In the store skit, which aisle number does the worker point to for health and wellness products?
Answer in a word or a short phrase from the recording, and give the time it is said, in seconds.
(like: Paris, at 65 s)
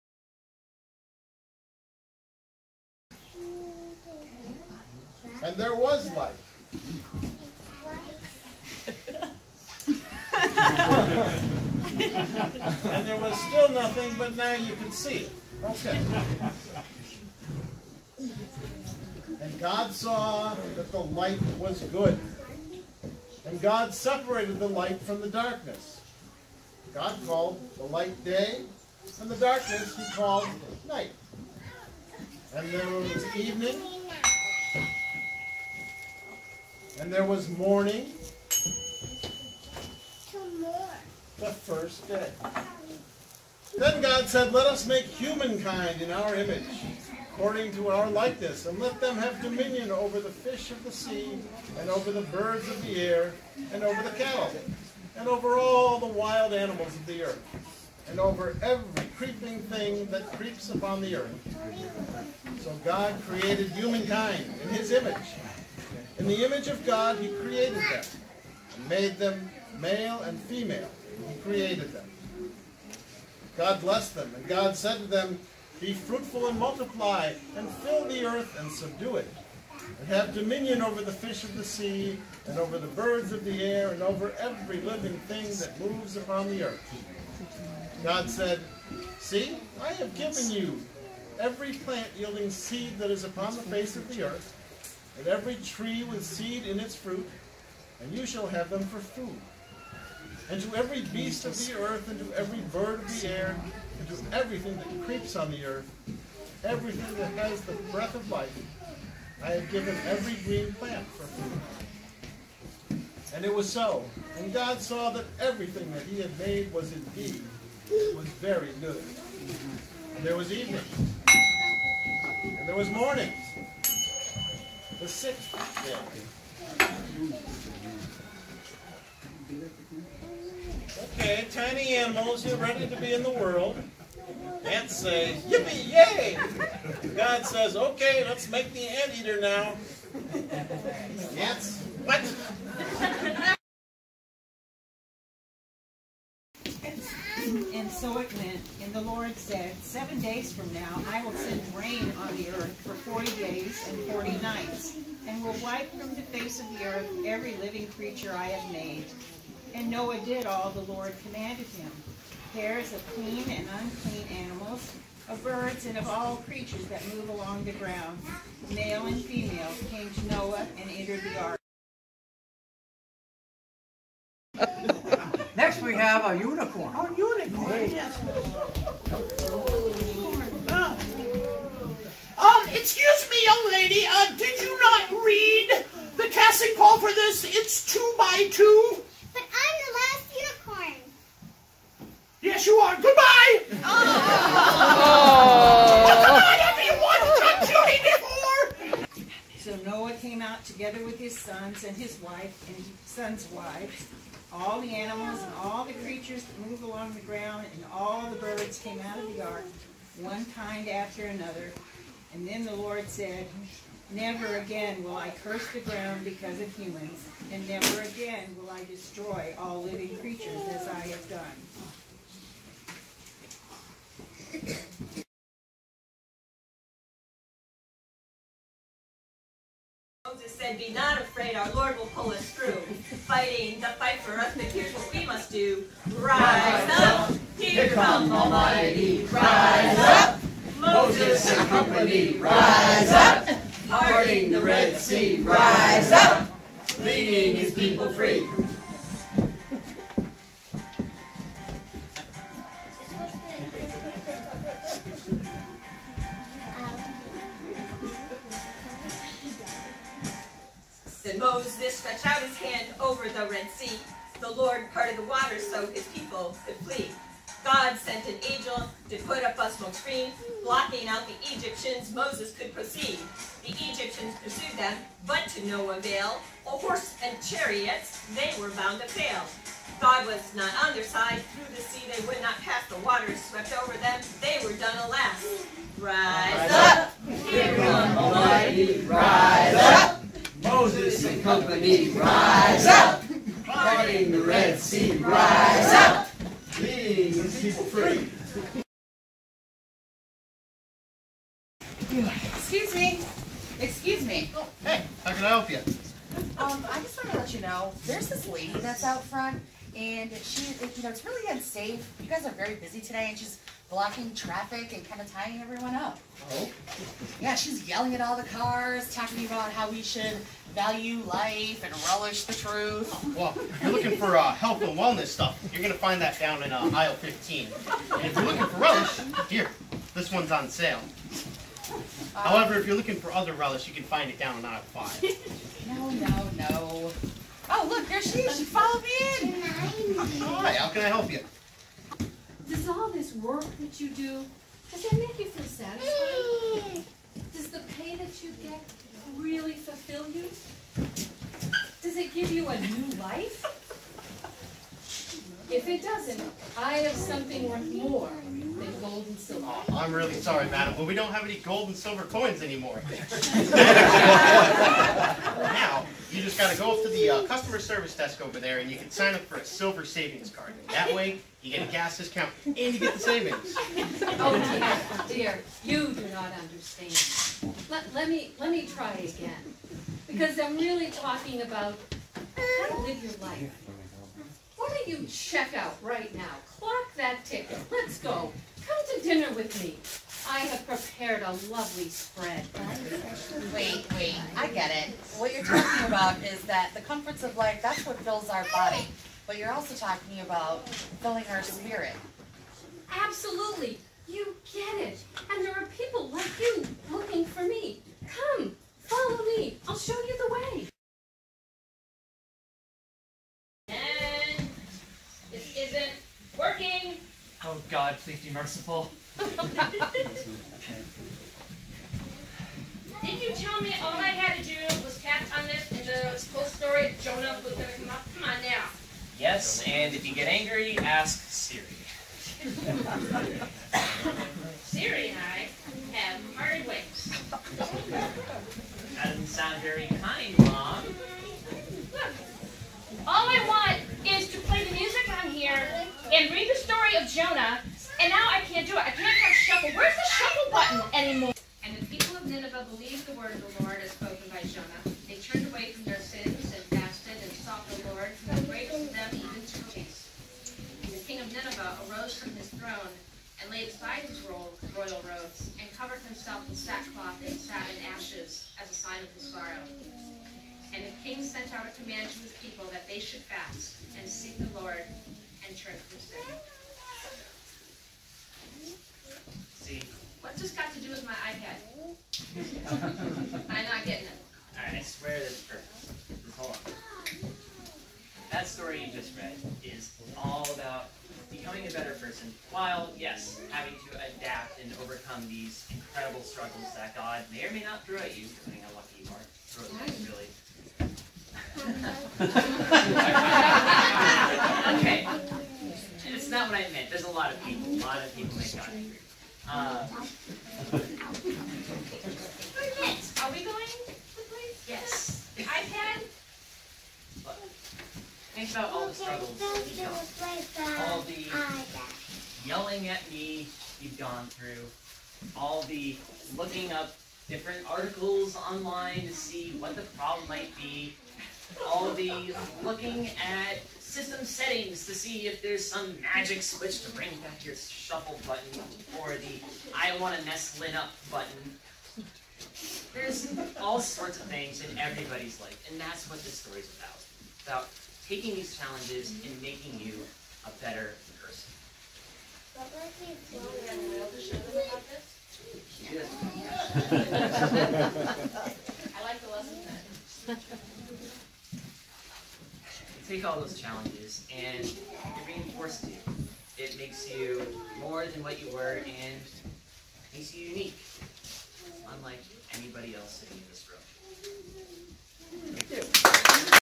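15, at 326 s.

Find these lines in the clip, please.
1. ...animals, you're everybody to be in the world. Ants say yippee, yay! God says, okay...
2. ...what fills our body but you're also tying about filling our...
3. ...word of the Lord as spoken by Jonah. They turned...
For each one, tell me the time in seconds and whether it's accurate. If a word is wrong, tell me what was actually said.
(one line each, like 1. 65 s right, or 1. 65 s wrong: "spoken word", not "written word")
1. 131 s wrong: "ready", not "everybody"
2. 398 s wrong: "talking", not "tying"
3. 453 s right.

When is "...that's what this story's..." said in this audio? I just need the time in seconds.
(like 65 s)
545 s.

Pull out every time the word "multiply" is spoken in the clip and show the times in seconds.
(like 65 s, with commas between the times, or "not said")
76 s.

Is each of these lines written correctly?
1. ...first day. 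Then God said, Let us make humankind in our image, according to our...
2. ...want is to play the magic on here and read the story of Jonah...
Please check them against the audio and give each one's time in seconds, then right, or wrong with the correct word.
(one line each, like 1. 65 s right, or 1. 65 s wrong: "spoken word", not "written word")
1. 41 s right
2. 443 s wrong: "music", not "magic".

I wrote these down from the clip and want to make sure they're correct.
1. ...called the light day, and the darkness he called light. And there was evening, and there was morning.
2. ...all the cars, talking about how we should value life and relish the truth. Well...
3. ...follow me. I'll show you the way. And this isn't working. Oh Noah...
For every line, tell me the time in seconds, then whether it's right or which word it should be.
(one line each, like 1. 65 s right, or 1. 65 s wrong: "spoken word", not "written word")
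1. 27 s wrong: "night", not "light"
2. 318 s right
3. 408 s wrong: "God", not "Noah".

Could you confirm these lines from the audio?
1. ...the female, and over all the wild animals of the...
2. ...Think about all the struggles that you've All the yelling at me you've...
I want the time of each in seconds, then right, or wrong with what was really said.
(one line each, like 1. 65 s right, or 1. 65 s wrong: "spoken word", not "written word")
1. 54 s wrong: "cattle", not "female"
2. 518 s right.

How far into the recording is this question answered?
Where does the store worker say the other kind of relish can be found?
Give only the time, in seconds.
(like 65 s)
334 s.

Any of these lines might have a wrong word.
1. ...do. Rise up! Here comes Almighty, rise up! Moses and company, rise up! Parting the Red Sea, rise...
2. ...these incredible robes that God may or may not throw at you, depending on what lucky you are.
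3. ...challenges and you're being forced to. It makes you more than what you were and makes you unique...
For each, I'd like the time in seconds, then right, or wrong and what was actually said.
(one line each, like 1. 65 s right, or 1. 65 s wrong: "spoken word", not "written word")
1. 235 s right
2. 495 s wrong: "struggles", not "robes"
3. 563 s right.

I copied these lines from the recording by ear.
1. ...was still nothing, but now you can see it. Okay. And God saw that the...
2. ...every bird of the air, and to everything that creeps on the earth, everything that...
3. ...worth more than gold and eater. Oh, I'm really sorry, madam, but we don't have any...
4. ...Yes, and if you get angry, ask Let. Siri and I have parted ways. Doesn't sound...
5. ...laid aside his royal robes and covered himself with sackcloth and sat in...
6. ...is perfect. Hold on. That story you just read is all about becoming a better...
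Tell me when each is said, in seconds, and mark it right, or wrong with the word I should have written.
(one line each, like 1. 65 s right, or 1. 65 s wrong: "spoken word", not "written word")
1. 13 s right
2. 102 s right
3. 357 s wrong: "silver", not "eater"
4. 429 s wrong: "Siri", not "Let"
5. 463 s right
6. 485 s right.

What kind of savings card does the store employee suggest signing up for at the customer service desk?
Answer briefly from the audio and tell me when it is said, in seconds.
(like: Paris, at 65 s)
Silver savings card, at 369 s.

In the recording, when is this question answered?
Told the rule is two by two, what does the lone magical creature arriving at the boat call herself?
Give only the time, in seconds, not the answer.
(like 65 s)
189 s.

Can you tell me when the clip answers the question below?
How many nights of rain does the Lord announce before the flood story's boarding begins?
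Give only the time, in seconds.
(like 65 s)
154 s.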